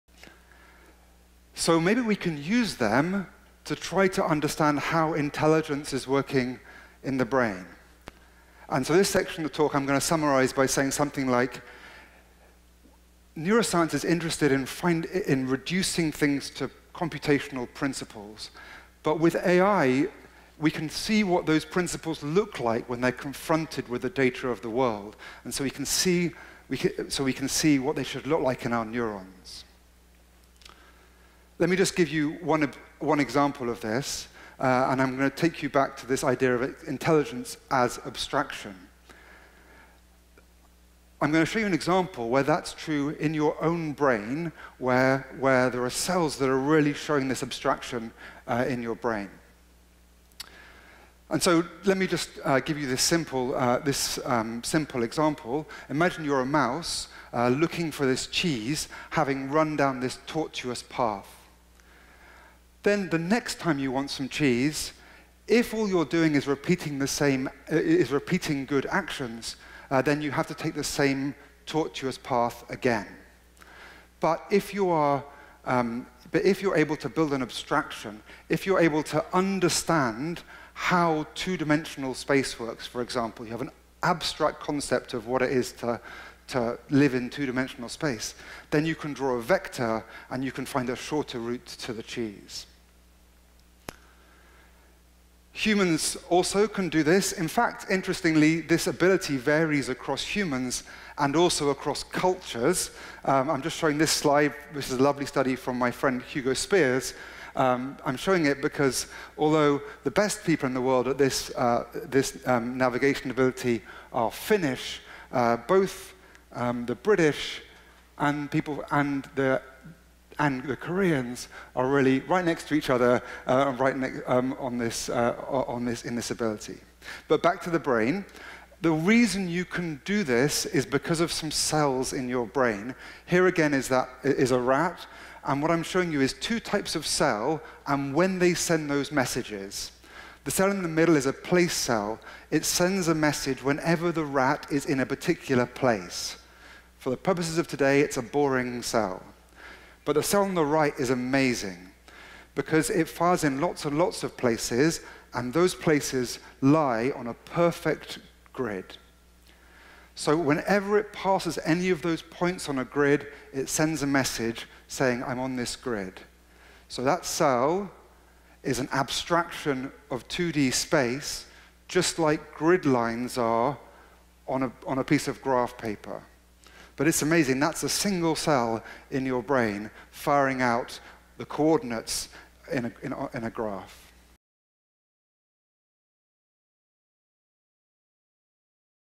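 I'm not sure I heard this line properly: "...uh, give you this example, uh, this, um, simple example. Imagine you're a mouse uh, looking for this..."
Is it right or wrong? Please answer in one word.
wrong.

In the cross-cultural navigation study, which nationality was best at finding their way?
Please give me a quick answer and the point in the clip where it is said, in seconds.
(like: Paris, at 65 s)
Finnish, at 114 s.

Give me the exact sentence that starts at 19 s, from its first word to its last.
But with AI, we can see what those principles look like when they're confronted with the data of the world.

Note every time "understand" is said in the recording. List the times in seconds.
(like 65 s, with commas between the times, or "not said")
4 s, 79 s.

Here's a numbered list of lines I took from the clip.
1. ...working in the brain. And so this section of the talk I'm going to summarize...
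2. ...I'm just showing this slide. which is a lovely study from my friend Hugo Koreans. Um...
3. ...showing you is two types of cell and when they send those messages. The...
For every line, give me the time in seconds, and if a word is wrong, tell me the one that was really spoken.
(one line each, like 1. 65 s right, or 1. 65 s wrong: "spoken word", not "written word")
1. 6 s right
2. 103 s wrong: "Spiers", not "Koreans"
3. 135 s right.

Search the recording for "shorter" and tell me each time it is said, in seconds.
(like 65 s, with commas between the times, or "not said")
90 s.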